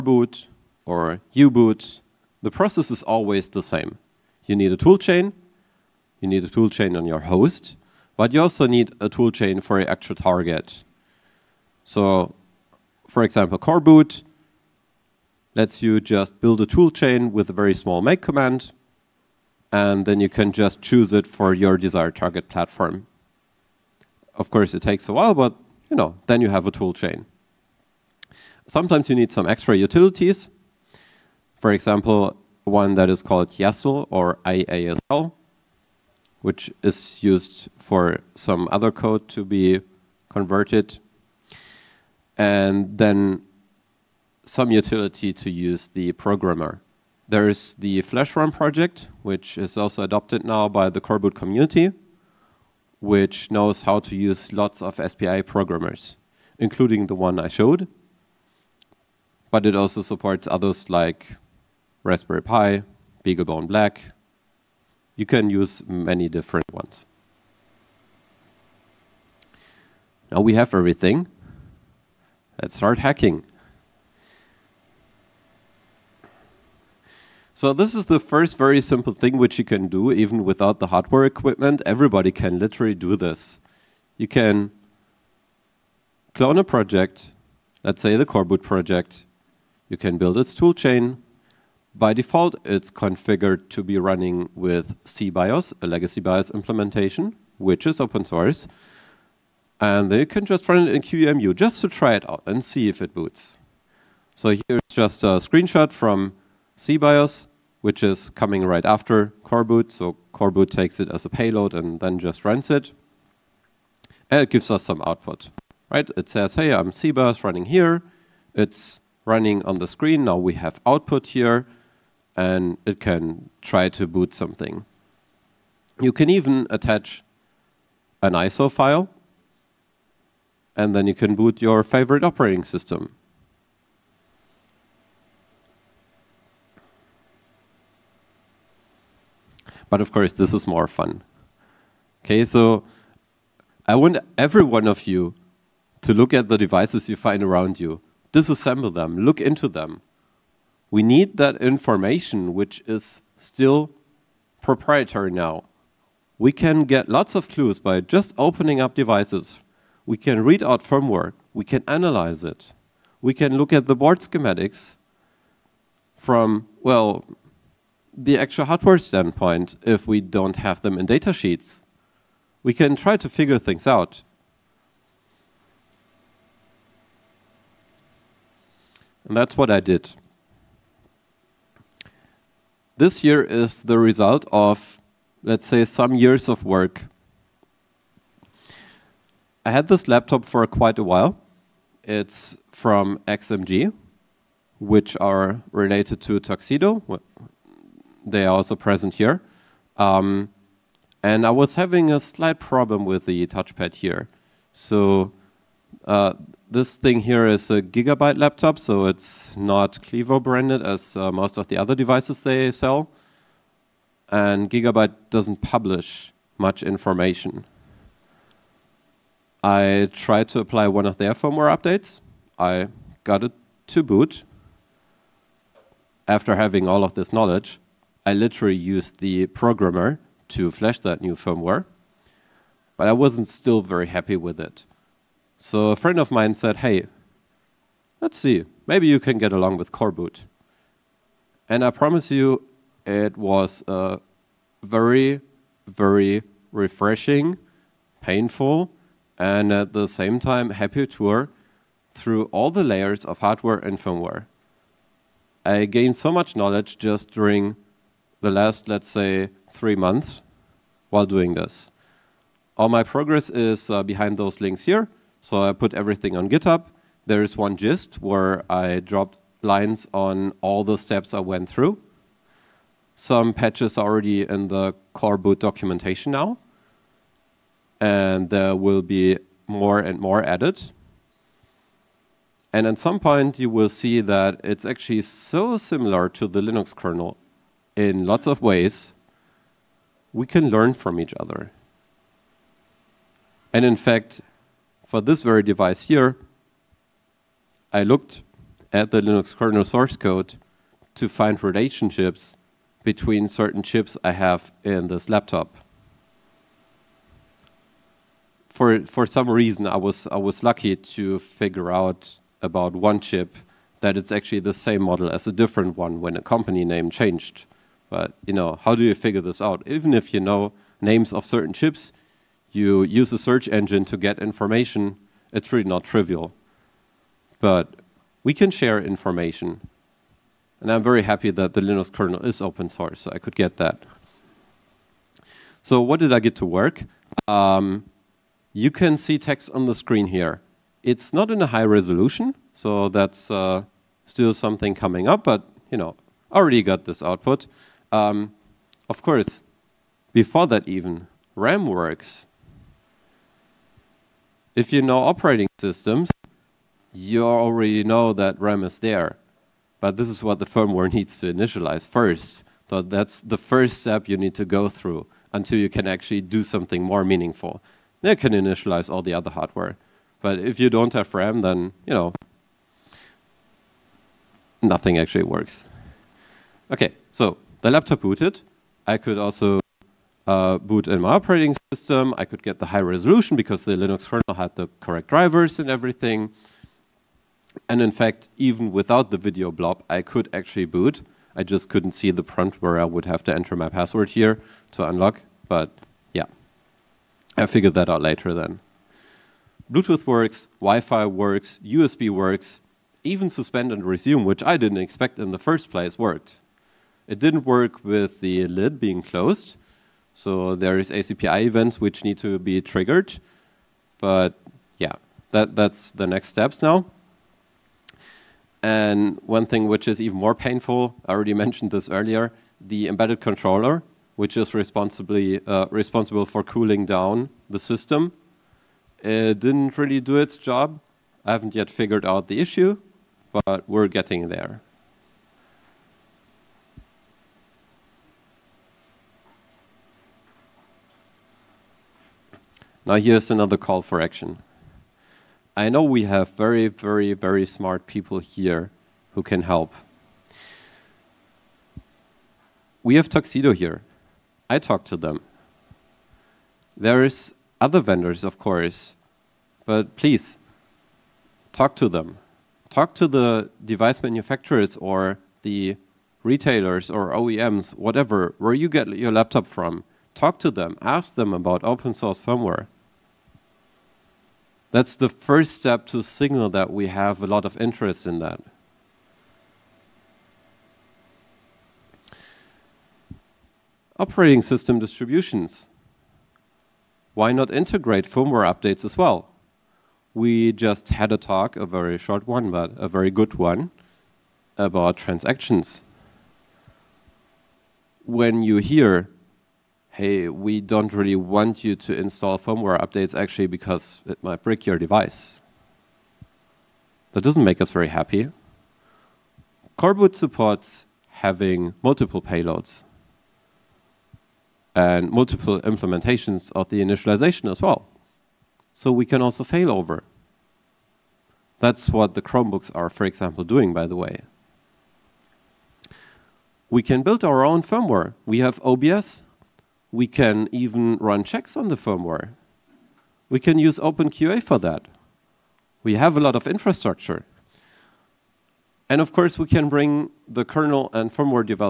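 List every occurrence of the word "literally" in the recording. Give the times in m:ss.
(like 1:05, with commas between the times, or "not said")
1:22, 3:48.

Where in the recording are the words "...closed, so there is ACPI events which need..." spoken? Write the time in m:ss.
6:49.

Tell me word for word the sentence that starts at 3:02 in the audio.
This year is the result of, let's say, some years of work.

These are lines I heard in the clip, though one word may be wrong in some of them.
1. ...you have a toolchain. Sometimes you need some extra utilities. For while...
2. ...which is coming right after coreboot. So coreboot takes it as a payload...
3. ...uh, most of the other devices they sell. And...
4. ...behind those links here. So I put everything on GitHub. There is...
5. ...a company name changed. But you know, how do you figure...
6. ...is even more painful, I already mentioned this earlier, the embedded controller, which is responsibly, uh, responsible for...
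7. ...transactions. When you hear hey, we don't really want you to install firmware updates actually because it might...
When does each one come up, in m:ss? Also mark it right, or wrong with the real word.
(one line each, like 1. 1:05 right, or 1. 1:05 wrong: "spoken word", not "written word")
1. 0:26 wrong: "example", not "while"
2. 1:47 right
3. 3:31 right
4. 4:24 right
5. 5:16 right
6. 7:00 right
7. 8:15 right.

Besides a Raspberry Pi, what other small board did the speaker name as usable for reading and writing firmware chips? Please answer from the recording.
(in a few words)
BeagleBone Black.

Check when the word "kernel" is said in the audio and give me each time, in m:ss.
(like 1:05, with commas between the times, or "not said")
4:46, 4:59, 5:32, 6:24, 9:00.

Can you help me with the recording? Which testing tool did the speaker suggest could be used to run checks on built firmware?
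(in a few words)
OpenQA.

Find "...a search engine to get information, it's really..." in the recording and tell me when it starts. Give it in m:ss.
5:23.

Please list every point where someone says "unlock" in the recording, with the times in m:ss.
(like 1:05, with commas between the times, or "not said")
6:35.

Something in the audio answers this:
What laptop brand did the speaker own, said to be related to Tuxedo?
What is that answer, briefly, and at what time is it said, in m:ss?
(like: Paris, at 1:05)
XMG, at 3:13.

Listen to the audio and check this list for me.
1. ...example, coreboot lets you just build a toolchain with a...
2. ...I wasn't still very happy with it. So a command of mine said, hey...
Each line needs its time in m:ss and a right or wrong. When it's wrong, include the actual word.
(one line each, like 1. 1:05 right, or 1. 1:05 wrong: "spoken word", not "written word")
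1. 0:13 right
2. 3:53 wrong: "friend", not "command".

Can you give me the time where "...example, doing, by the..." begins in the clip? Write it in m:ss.
8:43.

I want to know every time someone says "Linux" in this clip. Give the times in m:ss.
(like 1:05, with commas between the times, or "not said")
4:46, 4:59, 5:31, 6:23.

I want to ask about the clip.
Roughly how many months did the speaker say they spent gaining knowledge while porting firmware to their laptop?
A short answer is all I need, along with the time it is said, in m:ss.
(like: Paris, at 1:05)
3, at 4:19.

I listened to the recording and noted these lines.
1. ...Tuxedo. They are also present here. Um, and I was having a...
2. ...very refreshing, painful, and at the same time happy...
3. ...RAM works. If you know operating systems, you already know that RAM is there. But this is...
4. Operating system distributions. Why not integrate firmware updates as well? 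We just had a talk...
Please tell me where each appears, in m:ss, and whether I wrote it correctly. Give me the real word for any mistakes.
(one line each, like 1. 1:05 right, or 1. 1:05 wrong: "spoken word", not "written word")
1. 3:16 right
2. 4:05 right
3. 5:51 right
4. 8:04 right.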